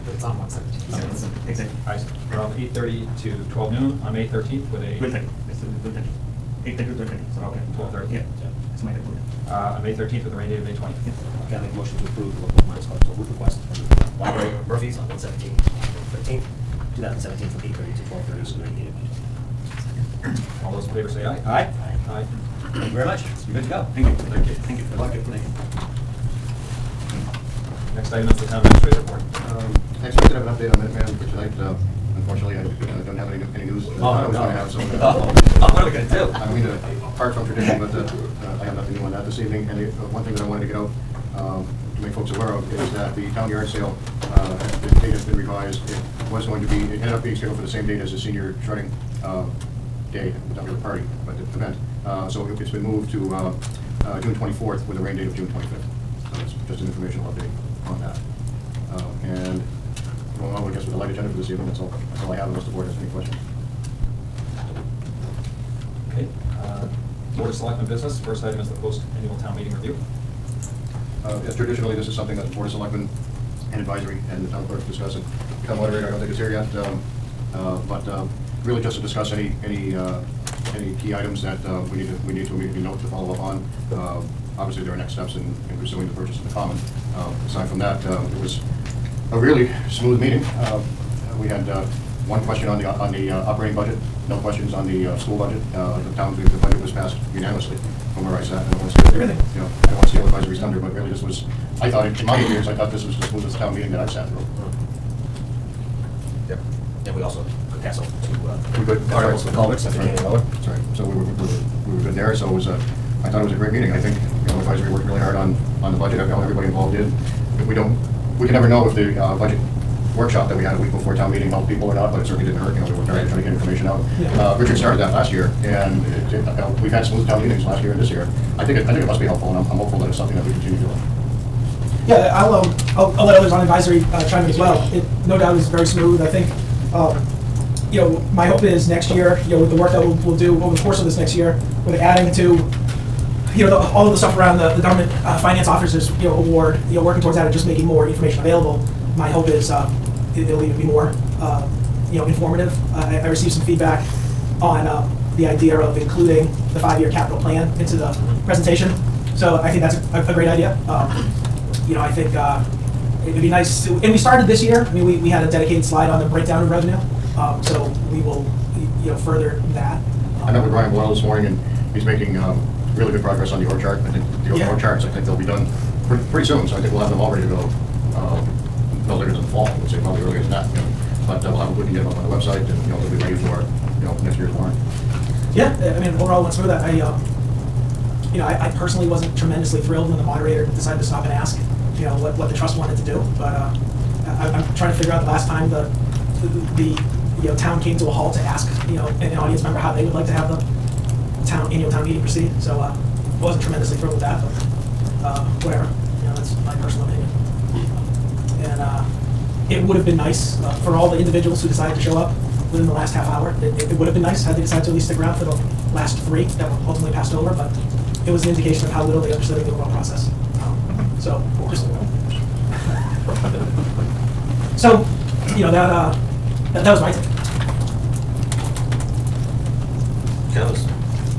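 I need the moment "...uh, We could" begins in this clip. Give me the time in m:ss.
1:48.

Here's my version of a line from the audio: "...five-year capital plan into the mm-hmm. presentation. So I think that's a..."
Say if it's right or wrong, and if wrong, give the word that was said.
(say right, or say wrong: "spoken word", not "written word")
right.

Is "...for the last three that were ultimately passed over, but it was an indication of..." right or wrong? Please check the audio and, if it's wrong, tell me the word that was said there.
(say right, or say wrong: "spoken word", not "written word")
right.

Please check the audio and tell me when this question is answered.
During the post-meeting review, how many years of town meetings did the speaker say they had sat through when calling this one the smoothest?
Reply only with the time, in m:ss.
1:42.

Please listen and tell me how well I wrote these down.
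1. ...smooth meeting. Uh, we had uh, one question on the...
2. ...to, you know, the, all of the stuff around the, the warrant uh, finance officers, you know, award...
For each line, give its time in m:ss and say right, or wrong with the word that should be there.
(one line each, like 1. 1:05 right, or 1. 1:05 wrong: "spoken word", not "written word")
1. 1:29 right
2. 2:22 wrong: "government", not "warrant".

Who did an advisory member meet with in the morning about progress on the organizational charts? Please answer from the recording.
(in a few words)
Brian Boyle.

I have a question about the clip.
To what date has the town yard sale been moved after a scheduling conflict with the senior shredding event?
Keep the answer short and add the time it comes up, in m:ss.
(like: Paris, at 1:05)
June 24, at 0:54.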